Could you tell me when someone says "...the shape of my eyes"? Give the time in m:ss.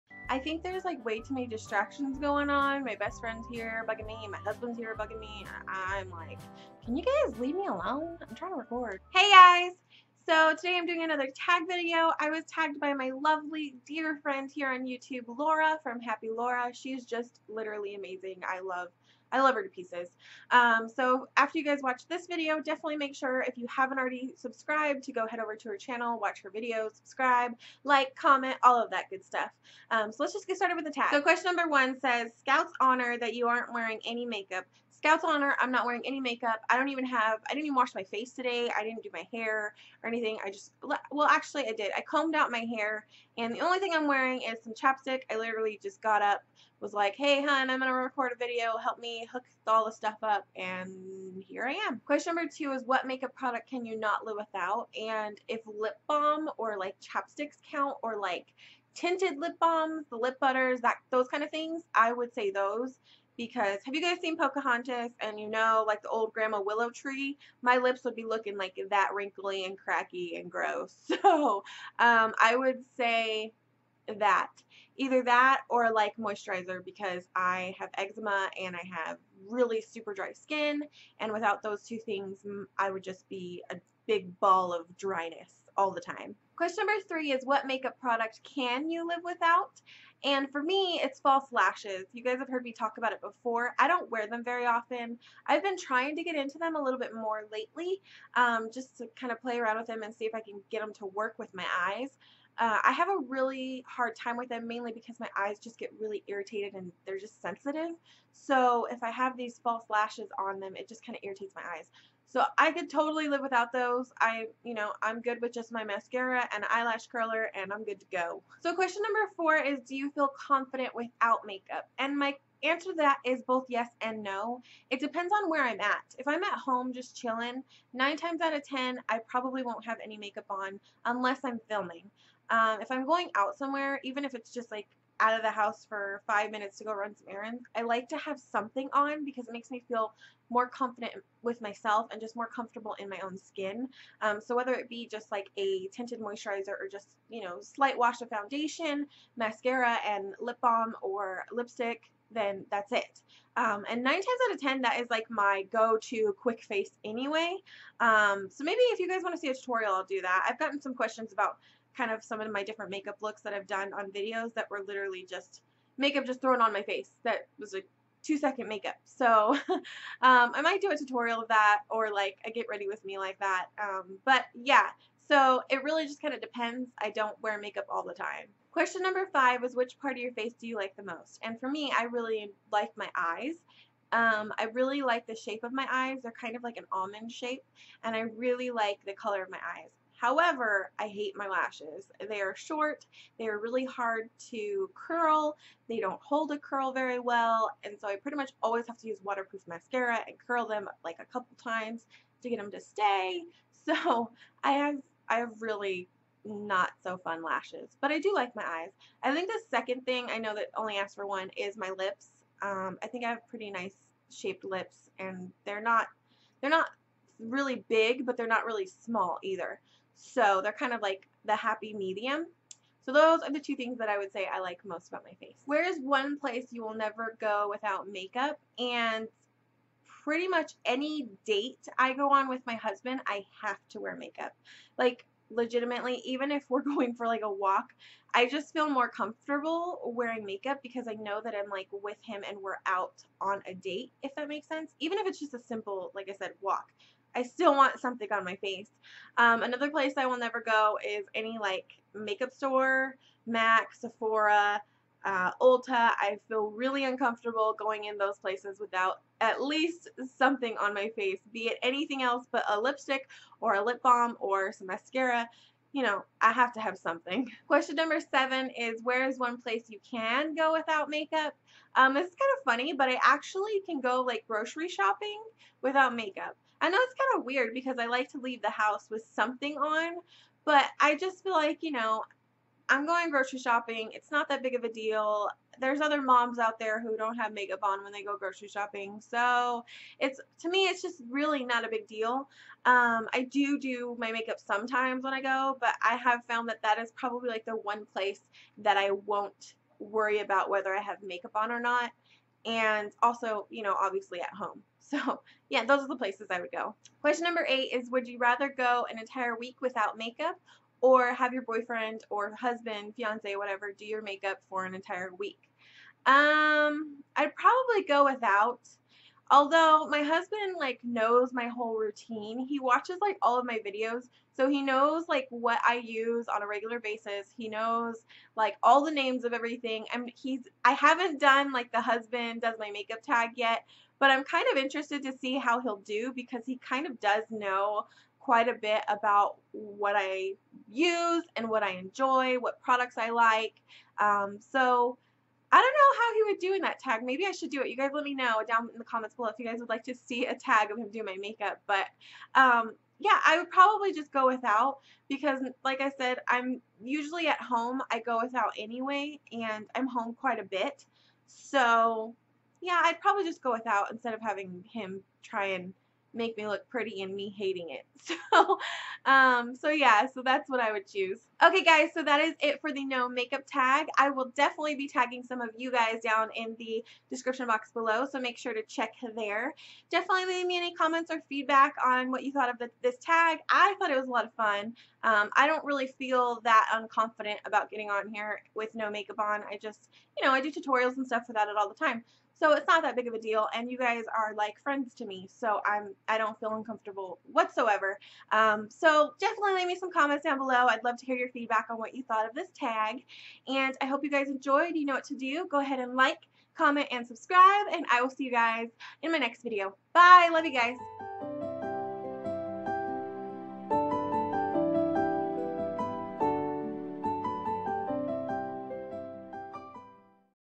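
3:05.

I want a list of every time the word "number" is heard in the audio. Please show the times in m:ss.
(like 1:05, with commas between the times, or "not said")
0:31, 0:52, 1:26, 1:59, 2:59, 4:27, 5:07.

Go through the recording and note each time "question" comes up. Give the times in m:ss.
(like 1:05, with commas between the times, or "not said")
0:31, 0:52, 1:26, 1:58, 2:40, 2:58, 4:27, 5:07.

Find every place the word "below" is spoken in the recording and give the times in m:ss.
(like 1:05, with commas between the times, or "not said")
5:49, 6:17, 6:40.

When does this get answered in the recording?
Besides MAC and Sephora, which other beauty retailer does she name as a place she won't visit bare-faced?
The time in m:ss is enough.
4:15.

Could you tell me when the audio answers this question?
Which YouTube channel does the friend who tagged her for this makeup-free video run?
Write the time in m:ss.
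0:15.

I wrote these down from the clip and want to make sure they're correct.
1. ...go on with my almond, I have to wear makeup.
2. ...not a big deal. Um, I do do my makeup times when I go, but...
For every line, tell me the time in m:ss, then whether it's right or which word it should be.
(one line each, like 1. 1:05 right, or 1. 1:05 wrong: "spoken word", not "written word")
1. 3:52 wrong: "husband", not "almond"
2. 4:51 wrong: "sometimes", not "times".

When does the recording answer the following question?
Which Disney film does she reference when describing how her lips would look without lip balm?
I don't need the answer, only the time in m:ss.
1:04.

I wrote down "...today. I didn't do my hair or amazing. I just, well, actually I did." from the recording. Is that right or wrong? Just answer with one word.
wrong.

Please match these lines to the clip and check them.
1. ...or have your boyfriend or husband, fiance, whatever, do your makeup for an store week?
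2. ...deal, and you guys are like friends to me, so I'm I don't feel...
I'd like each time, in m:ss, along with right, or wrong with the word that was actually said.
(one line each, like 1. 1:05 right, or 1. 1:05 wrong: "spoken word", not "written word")
1. 5:11 wrong: "entire", not "store"
2. 6:33 right.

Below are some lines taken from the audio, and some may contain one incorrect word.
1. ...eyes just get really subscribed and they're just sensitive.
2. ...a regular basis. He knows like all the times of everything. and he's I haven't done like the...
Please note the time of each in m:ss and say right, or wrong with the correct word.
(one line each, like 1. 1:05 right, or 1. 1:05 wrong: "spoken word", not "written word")
1. 1:45 wrong: "irritated", not "subscribed"
2. 5:26 wrong: "names", not "times".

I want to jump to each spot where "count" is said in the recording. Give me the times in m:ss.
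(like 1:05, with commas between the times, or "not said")
0:57.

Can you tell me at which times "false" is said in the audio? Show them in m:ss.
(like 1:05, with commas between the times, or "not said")
1:31, 1:49.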